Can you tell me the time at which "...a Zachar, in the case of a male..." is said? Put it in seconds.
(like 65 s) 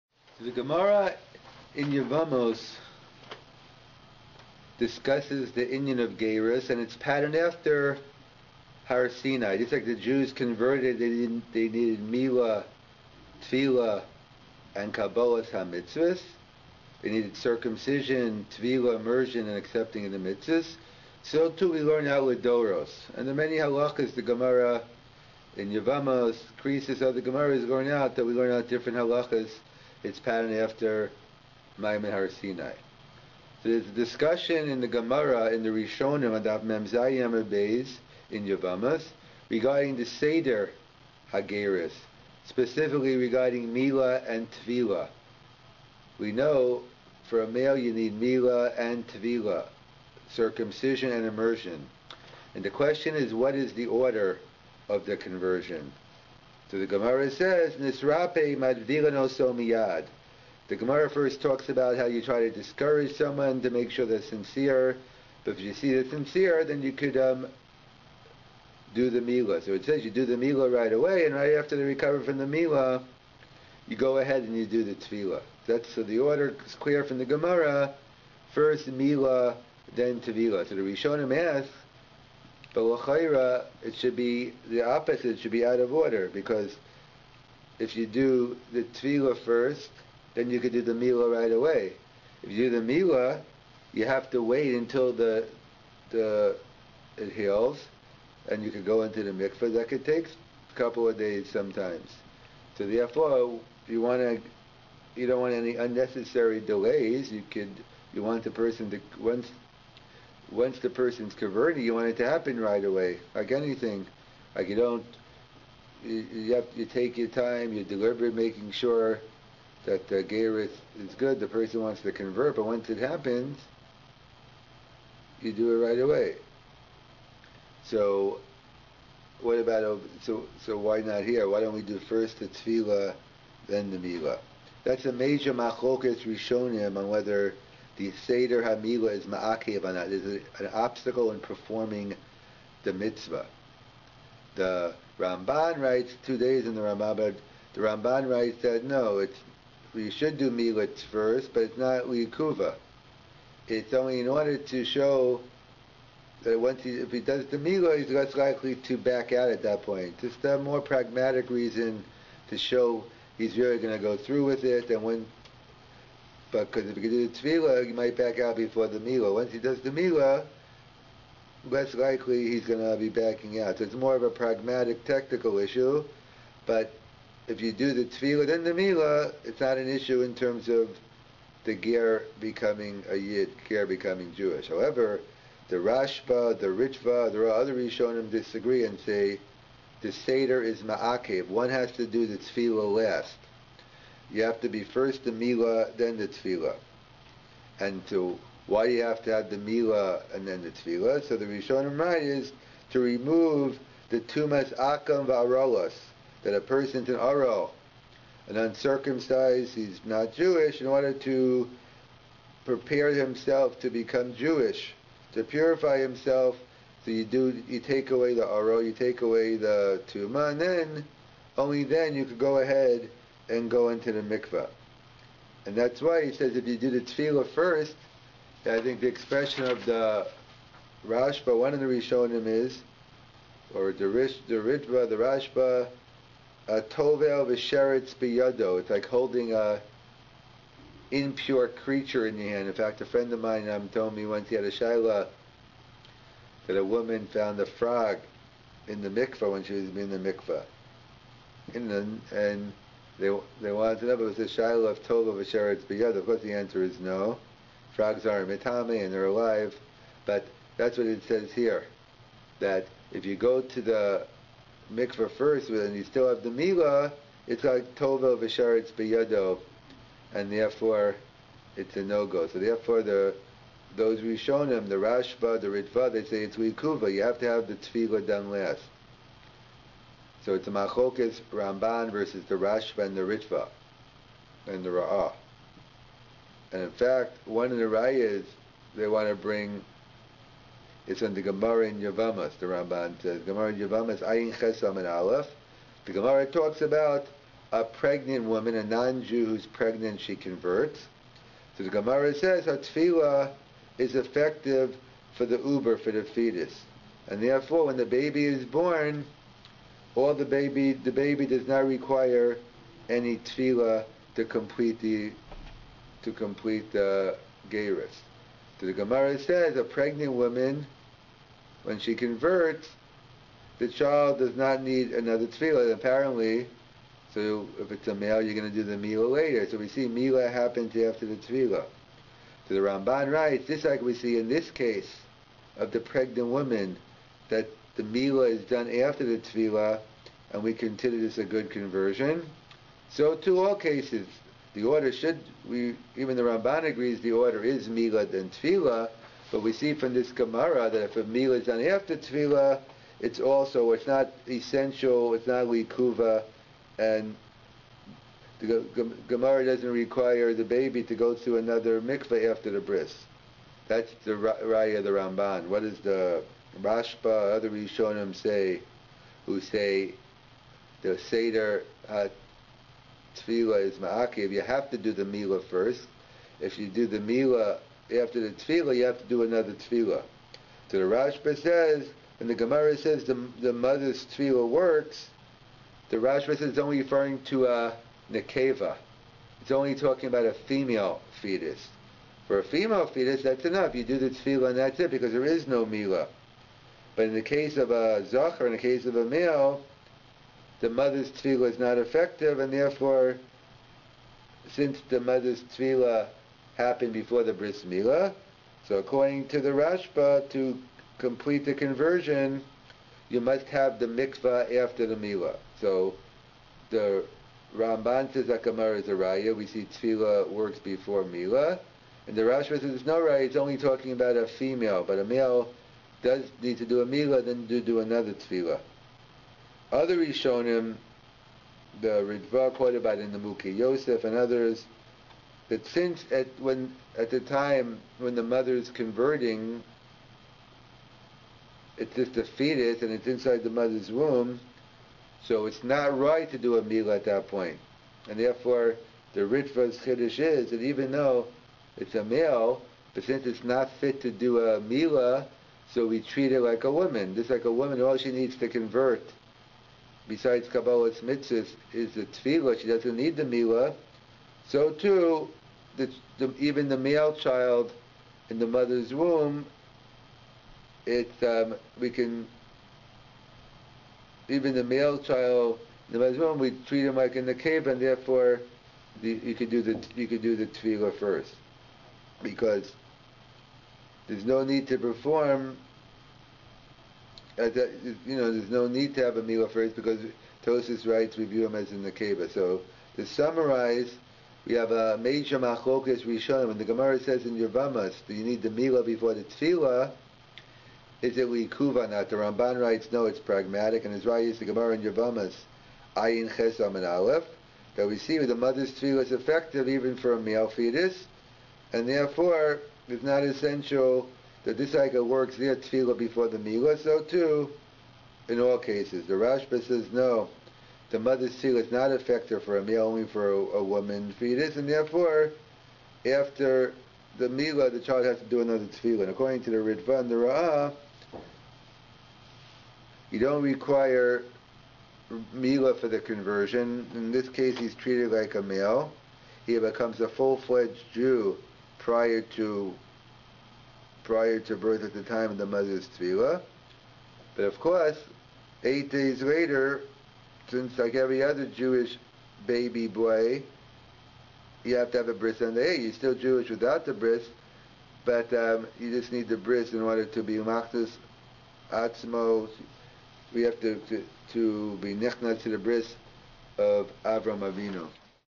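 397 s.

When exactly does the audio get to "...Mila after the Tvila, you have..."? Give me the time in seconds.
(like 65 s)
377 s.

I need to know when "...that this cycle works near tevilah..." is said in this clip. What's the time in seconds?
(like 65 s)
514 s.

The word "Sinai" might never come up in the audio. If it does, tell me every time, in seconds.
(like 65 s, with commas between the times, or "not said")
9 s, 32 s.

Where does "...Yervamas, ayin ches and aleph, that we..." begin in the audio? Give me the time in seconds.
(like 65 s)
505 s.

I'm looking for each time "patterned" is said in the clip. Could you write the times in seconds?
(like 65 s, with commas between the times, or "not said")
6 s, 30 s.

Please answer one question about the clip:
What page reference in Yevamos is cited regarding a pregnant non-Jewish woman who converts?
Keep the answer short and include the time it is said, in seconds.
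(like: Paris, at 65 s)
Ayin Ches Aleph (78a), at 294 s.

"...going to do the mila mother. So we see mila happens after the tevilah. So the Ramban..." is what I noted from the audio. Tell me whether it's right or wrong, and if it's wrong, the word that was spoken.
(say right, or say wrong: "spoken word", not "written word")
wrong: "later", not "mother".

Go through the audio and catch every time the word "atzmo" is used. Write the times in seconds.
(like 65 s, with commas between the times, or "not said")
561 s.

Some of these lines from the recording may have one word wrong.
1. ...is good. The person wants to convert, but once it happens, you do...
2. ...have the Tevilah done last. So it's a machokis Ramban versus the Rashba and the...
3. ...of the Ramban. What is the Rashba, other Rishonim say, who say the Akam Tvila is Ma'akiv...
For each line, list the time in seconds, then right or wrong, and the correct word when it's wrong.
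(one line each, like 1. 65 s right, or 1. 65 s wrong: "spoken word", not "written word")
1. 120 s right
2. 277 s right
3. 364 s wrong: "Seder", not "Akam".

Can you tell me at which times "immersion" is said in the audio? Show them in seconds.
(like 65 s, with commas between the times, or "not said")
18 s, 51 s.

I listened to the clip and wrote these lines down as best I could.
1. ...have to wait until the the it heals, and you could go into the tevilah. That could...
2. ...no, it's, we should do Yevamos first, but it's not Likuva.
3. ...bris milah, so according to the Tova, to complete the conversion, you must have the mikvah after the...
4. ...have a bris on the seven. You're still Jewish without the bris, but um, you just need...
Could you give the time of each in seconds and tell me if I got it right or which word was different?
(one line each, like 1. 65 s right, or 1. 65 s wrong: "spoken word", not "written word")
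1. 94 s wrong: "mikvah", not "tevilah"
2. 148 s wrong: "Militz", not "Yevamos"
3. 407 s wrong: "Rashba", not "Tova"
4. 555 s wrong: "eight", not "seven".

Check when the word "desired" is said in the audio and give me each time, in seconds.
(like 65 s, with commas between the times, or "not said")
not said.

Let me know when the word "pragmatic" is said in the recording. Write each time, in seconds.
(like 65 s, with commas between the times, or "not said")
160 s, 174 s, 503 s.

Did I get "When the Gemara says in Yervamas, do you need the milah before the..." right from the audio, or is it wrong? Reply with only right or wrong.
right.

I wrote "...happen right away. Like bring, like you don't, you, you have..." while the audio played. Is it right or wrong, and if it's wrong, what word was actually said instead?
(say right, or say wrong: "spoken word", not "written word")
wrong: "anything", not "bring".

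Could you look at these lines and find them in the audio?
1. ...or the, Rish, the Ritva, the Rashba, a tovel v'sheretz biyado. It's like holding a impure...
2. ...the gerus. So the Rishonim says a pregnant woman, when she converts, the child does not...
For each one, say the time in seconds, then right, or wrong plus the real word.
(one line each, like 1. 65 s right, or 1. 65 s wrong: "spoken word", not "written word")
1. 233 s right
2. 316 s wrong: "Gemara", not "Rishonim".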